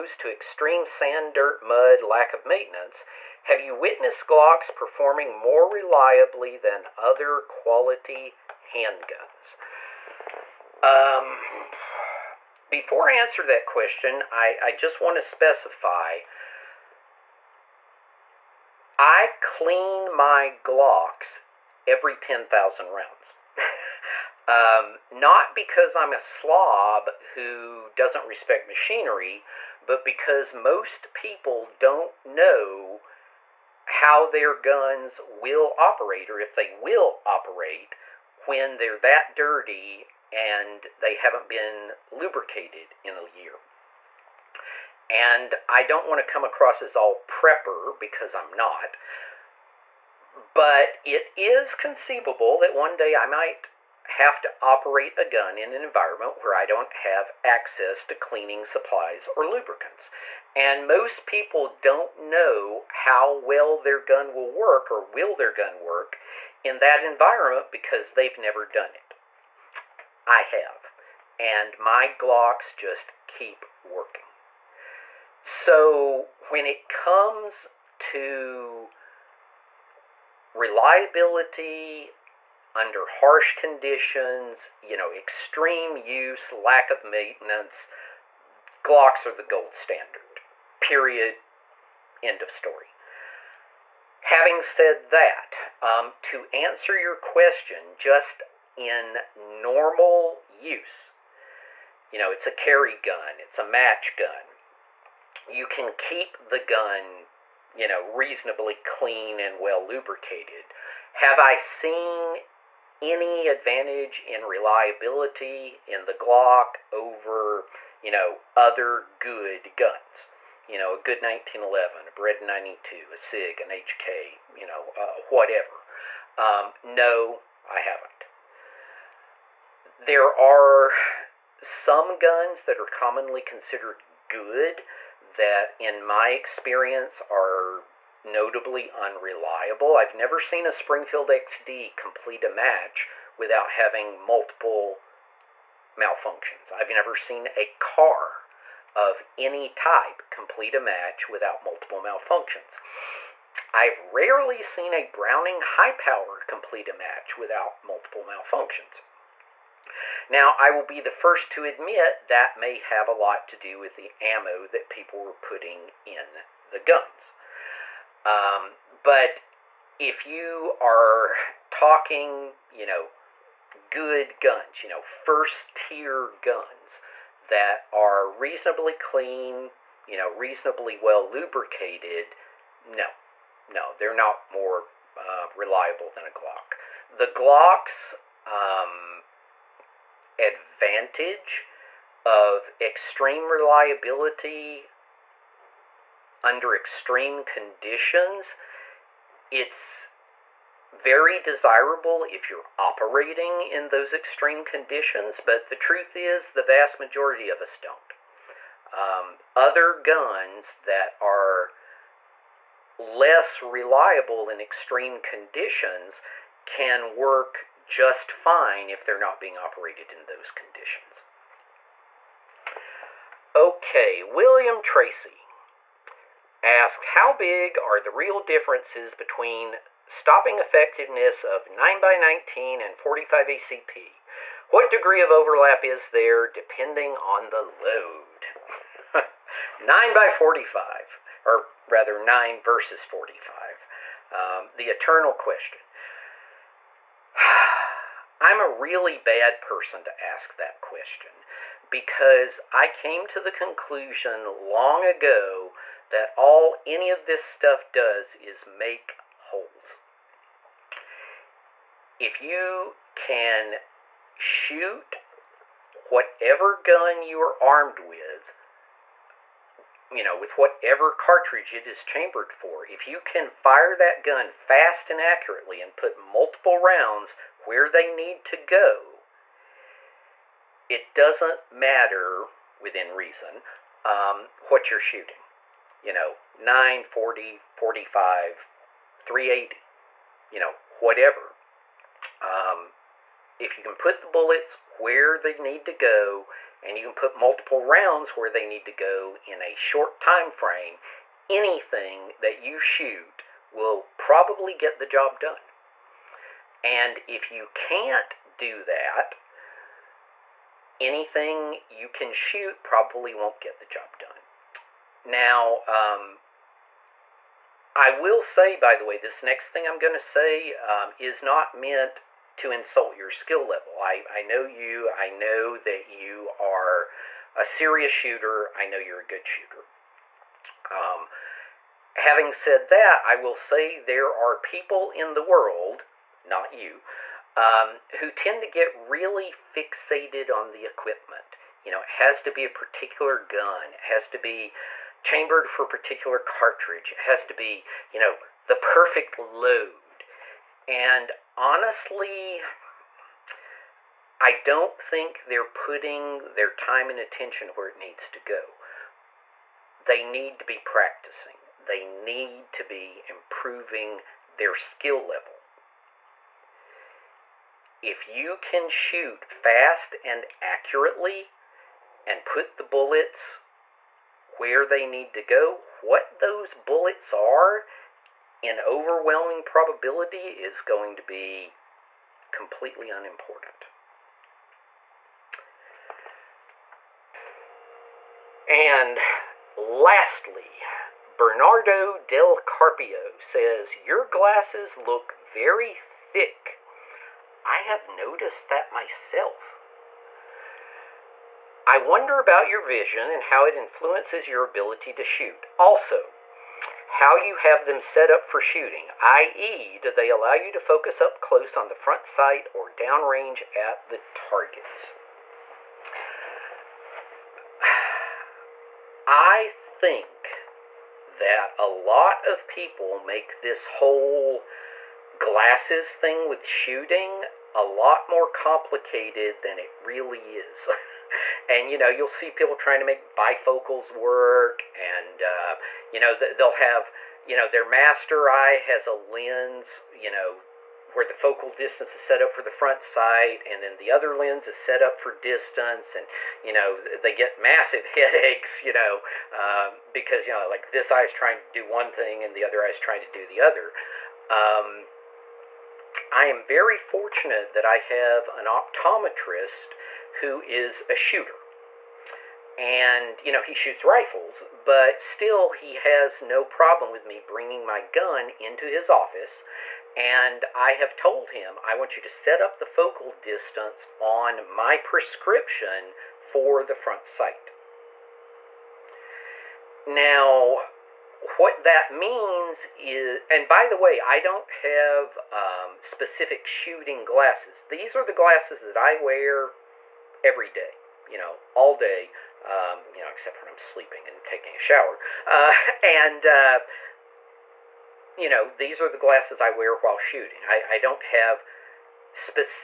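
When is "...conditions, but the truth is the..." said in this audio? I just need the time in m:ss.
3:24.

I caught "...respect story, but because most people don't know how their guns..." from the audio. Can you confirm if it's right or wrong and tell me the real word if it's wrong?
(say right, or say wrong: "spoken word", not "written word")
wrong: "machinery", not "story".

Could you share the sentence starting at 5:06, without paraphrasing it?
And if you can't do that, anything you can shoot probably won't get the job done.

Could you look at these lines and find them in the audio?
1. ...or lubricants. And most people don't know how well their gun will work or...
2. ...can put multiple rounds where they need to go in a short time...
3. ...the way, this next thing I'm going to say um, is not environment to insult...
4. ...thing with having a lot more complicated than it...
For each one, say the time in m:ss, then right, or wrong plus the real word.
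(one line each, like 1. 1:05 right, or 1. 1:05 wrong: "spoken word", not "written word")
1. 0:59 right
2. 4:57 right
3. 5:18 wrong: "meant", not "environment"
4. 7:06 wrong: "shooting", not "having".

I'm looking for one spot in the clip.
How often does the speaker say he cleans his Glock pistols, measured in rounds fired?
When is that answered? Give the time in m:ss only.
0:21.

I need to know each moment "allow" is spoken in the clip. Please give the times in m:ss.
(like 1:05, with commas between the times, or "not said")
6:50.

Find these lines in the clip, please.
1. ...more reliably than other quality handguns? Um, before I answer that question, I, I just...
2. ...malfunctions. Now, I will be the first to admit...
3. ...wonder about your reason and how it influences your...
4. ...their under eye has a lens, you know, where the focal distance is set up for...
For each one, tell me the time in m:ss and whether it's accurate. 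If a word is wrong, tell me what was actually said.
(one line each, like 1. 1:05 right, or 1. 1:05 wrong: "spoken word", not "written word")
1. 0:05 right
2. 2:38 right
3. 6:41 wrong: "vision", not "reason"
4. 7:17 wrong: "master", not "under".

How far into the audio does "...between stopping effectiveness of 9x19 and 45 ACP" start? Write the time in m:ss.
3:49.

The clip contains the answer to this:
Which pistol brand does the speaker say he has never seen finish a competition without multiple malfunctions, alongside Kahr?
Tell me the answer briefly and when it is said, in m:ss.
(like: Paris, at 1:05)
Springfield XD, at 2:20.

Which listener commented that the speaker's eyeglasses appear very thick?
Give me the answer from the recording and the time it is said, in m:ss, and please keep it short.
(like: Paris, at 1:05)
Bernardo del Carpio, at 6:31.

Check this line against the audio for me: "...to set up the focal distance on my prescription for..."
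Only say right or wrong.
right.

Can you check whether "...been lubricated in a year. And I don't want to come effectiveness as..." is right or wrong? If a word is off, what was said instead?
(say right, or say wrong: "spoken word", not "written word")
wrong: "across", not "effectiveness".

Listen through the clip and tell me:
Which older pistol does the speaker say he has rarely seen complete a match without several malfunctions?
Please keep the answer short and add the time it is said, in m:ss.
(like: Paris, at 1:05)
Browning High Power, at 2:35.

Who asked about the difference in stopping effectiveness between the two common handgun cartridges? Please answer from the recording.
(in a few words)
William Tracy.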